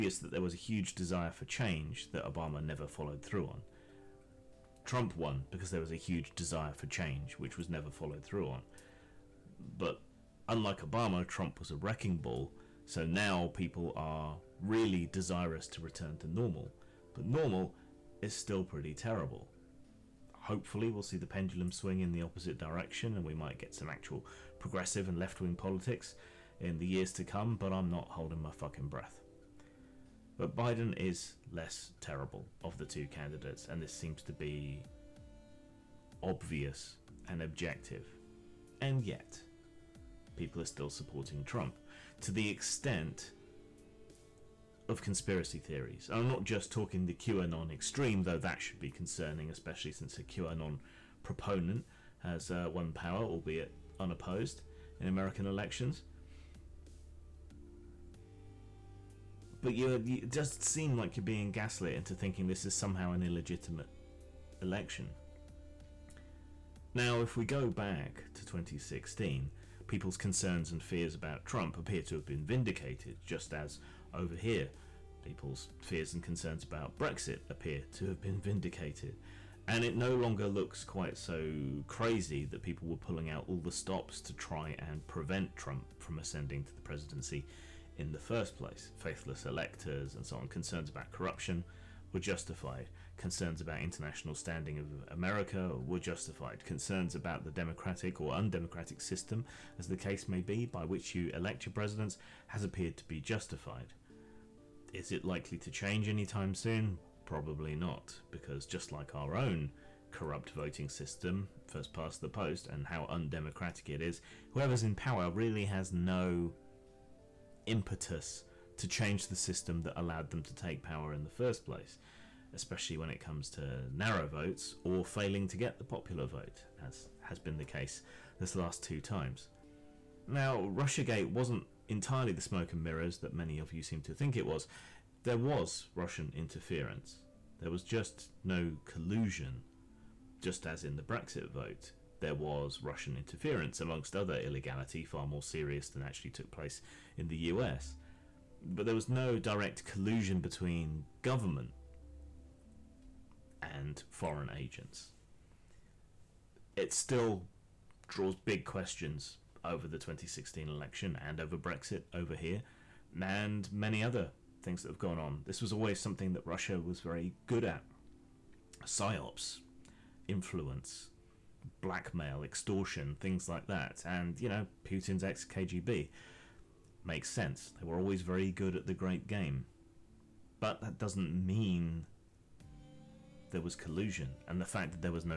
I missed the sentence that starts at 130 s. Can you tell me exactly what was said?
Now, Russiagate wasn't entirely the smoke and mirrors that many of you seem to think it was.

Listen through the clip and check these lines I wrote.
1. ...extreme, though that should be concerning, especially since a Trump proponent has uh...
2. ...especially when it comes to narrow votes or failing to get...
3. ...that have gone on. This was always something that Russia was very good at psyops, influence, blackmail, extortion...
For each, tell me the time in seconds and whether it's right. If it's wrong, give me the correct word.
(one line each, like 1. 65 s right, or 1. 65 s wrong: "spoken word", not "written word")
1. 47 s wrong: "QAnon", not "Trump"
2. 122 s right
3. 164 s right.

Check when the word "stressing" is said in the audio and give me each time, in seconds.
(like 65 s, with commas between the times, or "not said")
not said.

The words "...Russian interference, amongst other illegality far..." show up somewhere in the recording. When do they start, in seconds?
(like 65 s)
142 s.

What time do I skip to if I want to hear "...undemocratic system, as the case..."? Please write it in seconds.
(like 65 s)
98 s.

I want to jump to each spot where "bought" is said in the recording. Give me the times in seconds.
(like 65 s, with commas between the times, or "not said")
not said.